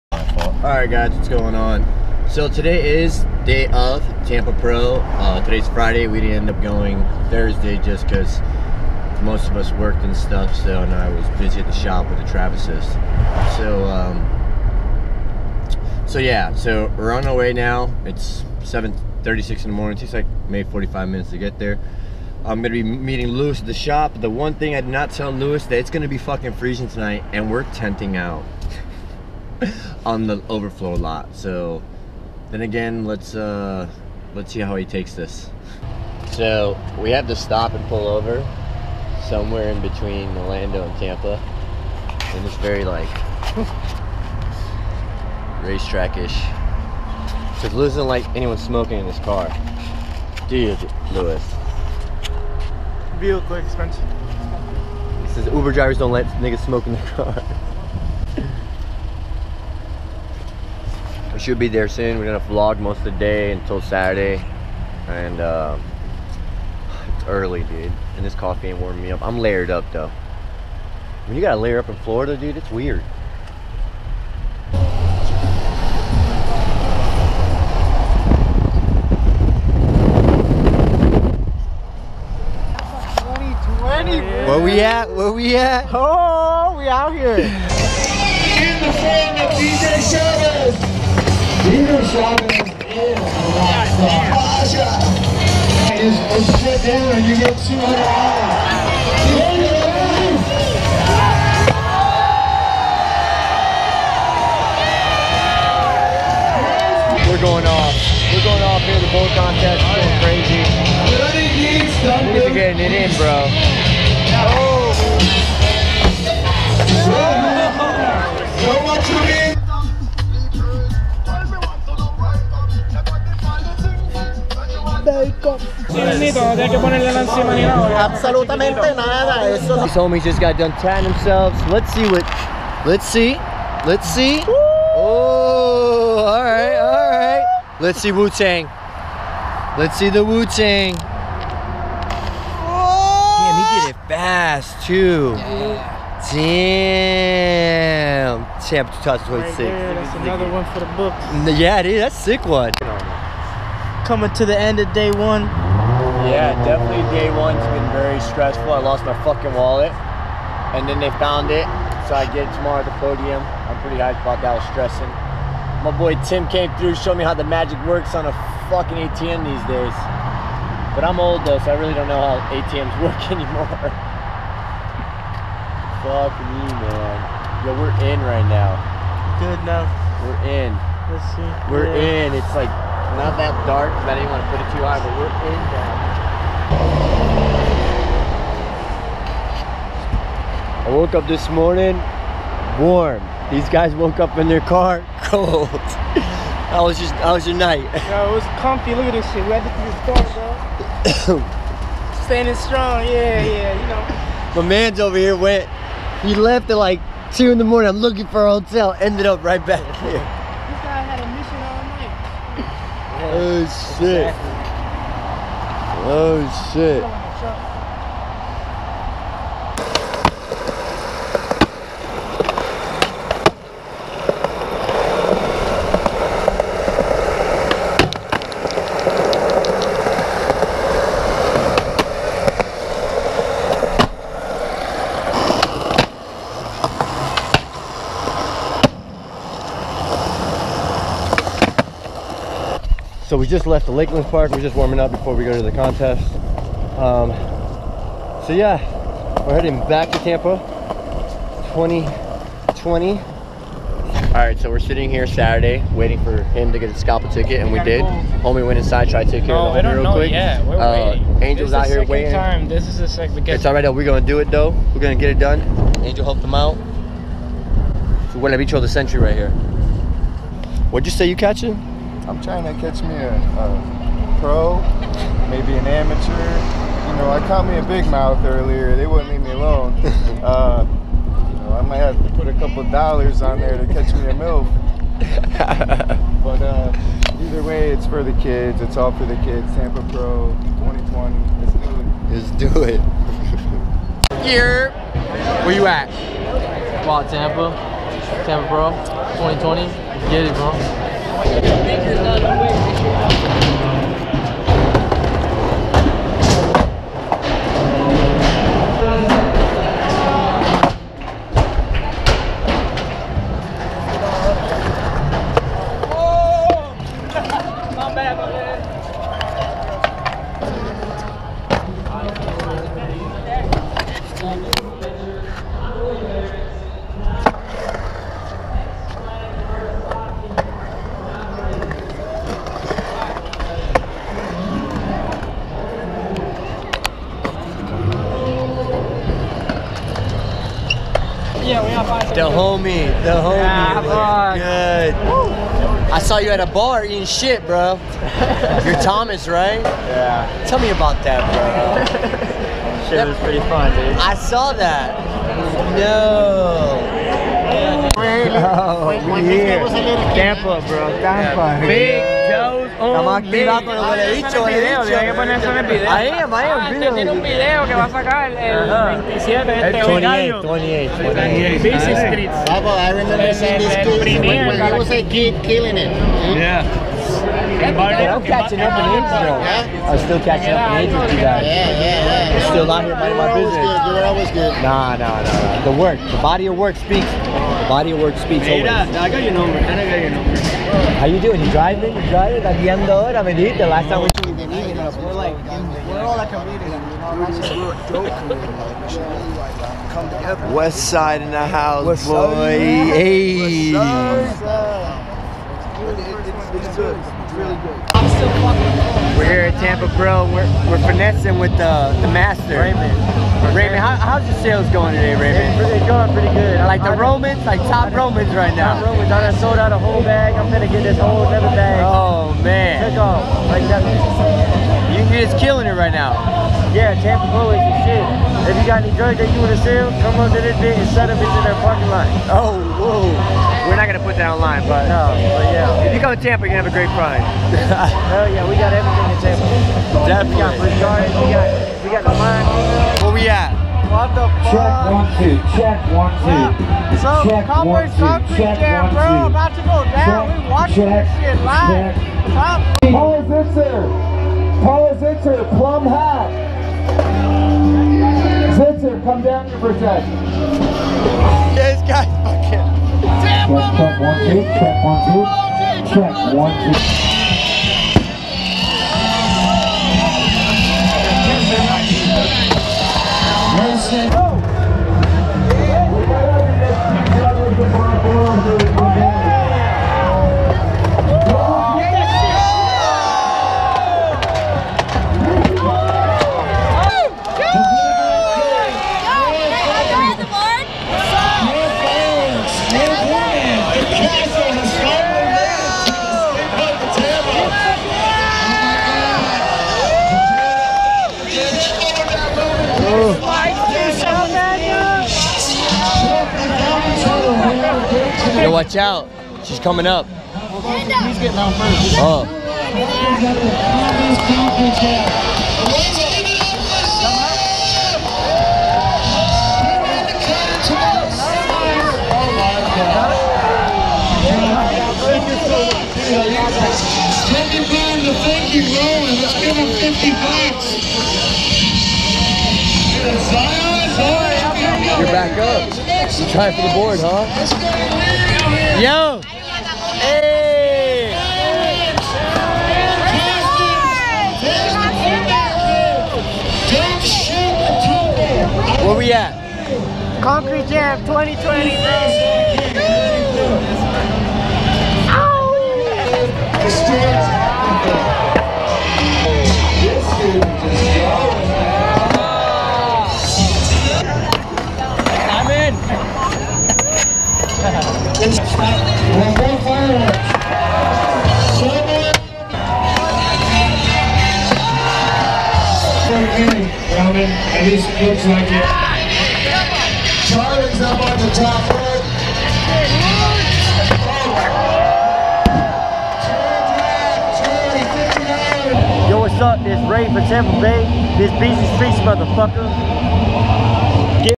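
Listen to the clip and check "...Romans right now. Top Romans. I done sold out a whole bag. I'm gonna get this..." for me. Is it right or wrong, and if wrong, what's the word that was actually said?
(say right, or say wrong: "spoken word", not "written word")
right.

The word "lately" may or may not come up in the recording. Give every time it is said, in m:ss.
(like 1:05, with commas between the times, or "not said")
not said.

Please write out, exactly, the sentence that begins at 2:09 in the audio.
These homies just got done tying themselves.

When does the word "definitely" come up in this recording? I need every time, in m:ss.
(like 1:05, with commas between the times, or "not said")
2:36, 7:19.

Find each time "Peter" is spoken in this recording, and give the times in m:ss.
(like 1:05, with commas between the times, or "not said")
1:31.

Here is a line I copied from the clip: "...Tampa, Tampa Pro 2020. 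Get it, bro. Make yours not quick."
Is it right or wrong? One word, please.
right.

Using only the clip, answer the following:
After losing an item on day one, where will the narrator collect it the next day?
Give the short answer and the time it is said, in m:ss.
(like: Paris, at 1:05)
at the podium, at 2:42.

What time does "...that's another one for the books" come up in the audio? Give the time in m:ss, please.
2:29.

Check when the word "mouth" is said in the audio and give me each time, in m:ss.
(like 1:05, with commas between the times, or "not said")
4:38.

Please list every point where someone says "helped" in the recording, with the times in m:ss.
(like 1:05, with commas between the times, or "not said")
4:26.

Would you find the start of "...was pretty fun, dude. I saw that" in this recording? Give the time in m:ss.
5:53.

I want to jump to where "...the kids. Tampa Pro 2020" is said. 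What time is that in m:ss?
4:49.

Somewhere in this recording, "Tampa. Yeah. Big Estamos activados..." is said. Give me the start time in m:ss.
6:01.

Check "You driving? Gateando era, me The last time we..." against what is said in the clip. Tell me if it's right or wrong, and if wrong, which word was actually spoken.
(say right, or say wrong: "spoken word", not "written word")
right.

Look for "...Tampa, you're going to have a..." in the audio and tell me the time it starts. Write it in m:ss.
7:16.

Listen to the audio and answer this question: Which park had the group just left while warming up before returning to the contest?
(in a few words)
Lakeland Park.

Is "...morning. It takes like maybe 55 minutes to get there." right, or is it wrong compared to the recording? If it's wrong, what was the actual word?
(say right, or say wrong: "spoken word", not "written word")
wrong: "45", not "55".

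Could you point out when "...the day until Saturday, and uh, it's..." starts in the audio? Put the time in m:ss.
1:03.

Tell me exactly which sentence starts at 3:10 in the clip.
I woke up this morning warm.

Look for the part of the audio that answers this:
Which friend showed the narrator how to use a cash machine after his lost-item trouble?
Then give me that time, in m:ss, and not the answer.
2:46.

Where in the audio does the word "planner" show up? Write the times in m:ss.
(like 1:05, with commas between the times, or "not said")
not said.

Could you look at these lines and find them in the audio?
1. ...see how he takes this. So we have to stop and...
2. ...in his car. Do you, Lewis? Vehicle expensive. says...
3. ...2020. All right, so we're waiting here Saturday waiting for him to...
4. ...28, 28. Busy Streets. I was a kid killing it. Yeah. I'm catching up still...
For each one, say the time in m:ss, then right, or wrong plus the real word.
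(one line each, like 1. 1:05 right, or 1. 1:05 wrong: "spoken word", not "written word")
1. 0:34 right
2. 0:48 right
3. 4:11 wrong: "sitting", not "waiting"
4. 6:10 right.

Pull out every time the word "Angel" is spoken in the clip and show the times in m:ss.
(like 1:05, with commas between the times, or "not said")
4:21, 4:26.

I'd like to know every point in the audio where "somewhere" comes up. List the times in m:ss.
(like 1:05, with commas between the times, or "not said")
0:39.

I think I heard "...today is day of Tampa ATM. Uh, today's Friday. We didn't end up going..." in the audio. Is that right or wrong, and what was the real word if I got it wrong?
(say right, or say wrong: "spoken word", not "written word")
wrong: "Pro", not "ATM".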